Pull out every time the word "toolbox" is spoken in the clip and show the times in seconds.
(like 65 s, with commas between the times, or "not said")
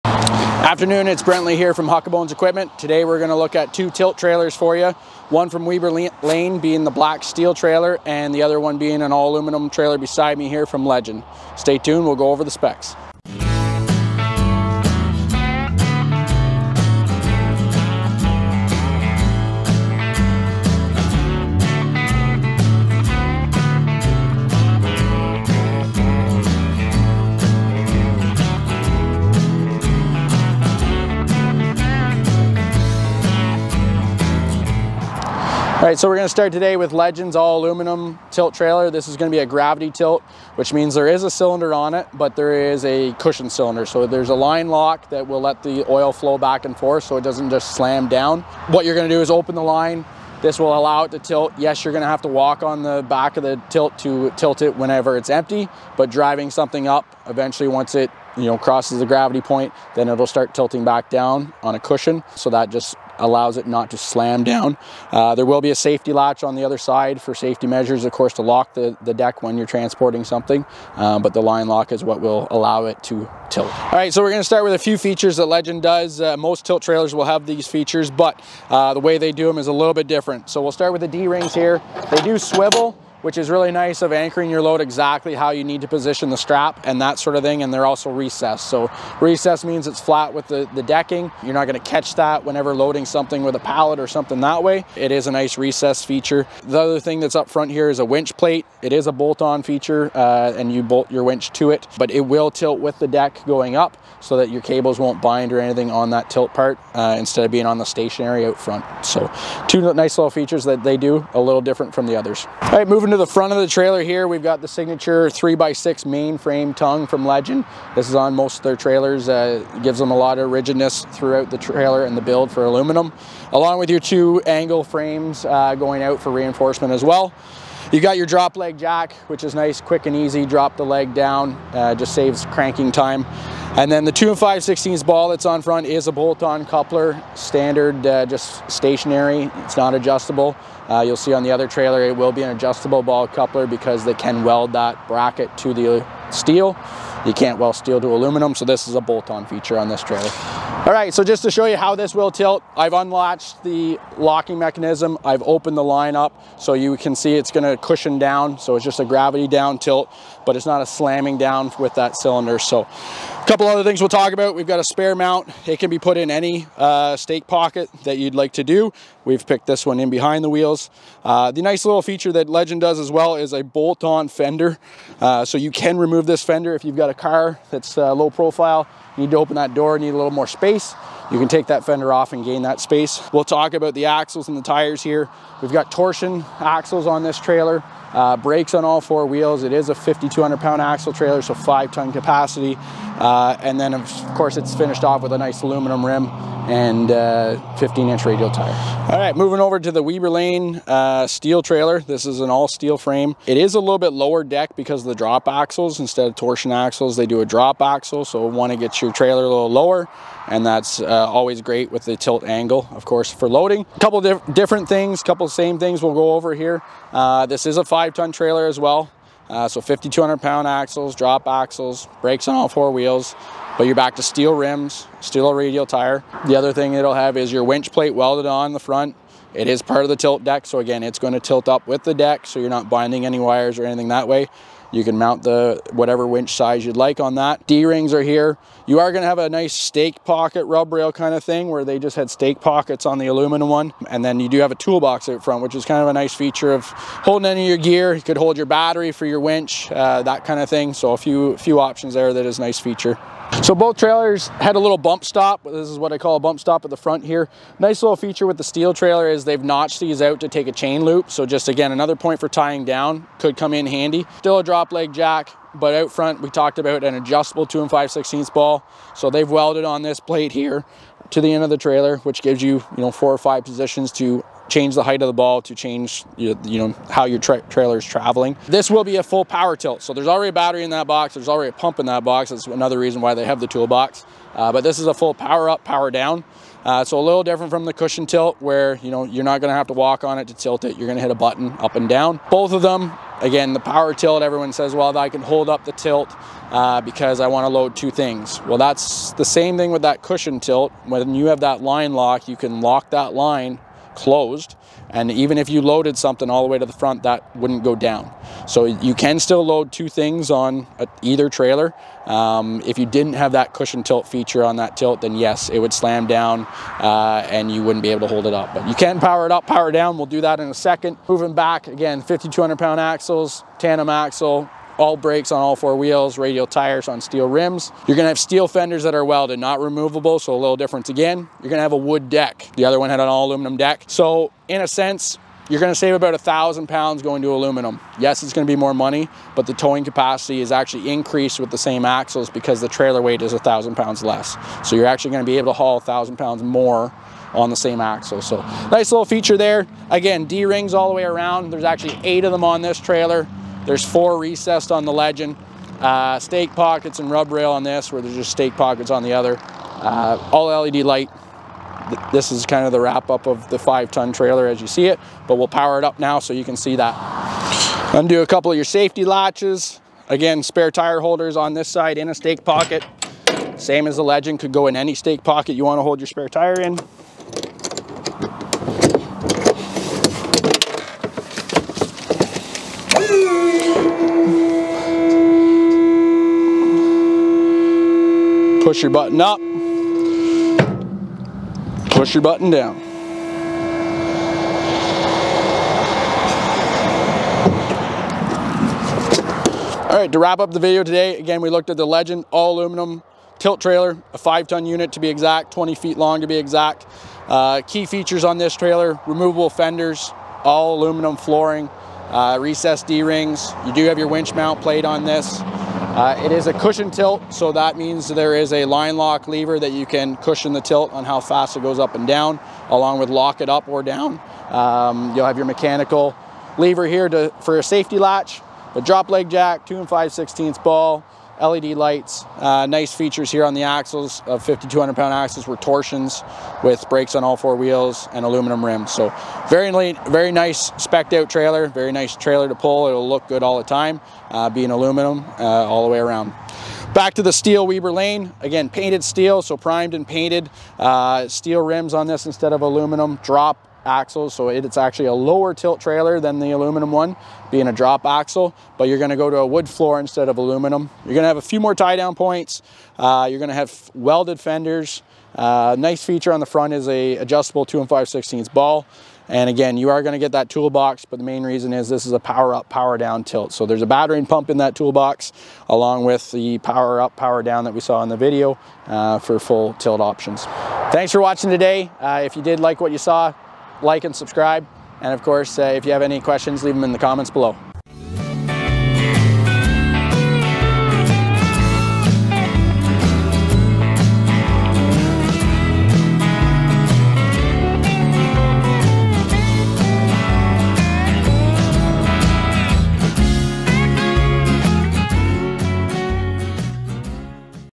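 244 s, 283 s, 470 s, 474 s.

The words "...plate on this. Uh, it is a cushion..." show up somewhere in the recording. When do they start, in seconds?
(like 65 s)
414 s.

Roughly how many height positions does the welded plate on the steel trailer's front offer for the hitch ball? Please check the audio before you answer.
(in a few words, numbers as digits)
4 or 5.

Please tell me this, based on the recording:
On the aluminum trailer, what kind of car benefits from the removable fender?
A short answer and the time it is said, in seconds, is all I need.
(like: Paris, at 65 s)
Low profile, at 178 s.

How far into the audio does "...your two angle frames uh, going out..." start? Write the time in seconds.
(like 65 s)
123 s.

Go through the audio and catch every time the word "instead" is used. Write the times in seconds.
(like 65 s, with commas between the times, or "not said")
107 s, 206 s, 452 s, 460 s.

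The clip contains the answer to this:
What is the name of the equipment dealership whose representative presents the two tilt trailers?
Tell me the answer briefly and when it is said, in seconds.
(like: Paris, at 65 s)
Huckabones Equipment, at 1 s.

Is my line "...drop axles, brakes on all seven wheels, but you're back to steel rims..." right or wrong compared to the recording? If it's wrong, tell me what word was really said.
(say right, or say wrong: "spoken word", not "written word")
wrong: "four", not "seven".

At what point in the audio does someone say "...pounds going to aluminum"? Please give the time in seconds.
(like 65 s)
336 s.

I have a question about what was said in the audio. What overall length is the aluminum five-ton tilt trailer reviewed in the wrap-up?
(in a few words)
20 feet.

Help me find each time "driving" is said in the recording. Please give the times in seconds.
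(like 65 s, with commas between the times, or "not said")
56 s.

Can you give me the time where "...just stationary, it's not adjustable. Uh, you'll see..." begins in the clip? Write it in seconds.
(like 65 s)
138 s.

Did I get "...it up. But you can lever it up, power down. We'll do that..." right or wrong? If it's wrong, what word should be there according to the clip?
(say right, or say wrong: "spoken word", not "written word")
wrong: "power", not "lever".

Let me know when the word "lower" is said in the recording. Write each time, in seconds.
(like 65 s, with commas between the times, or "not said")
204 s, 209 s, 455 s.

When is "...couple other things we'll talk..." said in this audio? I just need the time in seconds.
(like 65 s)
163 s.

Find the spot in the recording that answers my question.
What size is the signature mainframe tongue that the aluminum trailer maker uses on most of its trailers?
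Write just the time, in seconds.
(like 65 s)
115 s.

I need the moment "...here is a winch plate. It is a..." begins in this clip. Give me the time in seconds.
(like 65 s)
97 s.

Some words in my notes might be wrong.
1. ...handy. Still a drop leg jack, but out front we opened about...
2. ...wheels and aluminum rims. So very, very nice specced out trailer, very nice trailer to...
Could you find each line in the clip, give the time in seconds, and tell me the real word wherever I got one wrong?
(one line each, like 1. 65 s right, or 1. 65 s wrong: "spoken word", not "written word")
1. 263 s wrong: "talked", not "opened"
2. 437 s right.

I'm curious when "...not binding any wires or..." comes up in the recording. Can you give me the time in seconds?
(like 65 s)
232 s.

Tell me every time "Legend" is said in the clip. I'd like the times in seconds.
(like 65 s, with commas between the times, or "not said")
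10 s, 36 s, 75 s, 117 s, 172 s, 355 s, 374 s, 402 s.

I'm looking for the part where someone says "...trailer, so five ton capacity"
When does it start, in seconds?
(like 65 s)
191 s.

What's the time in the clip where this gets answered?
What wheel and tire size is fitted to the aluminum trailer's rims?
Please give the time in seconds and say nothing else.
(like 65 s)
197 s.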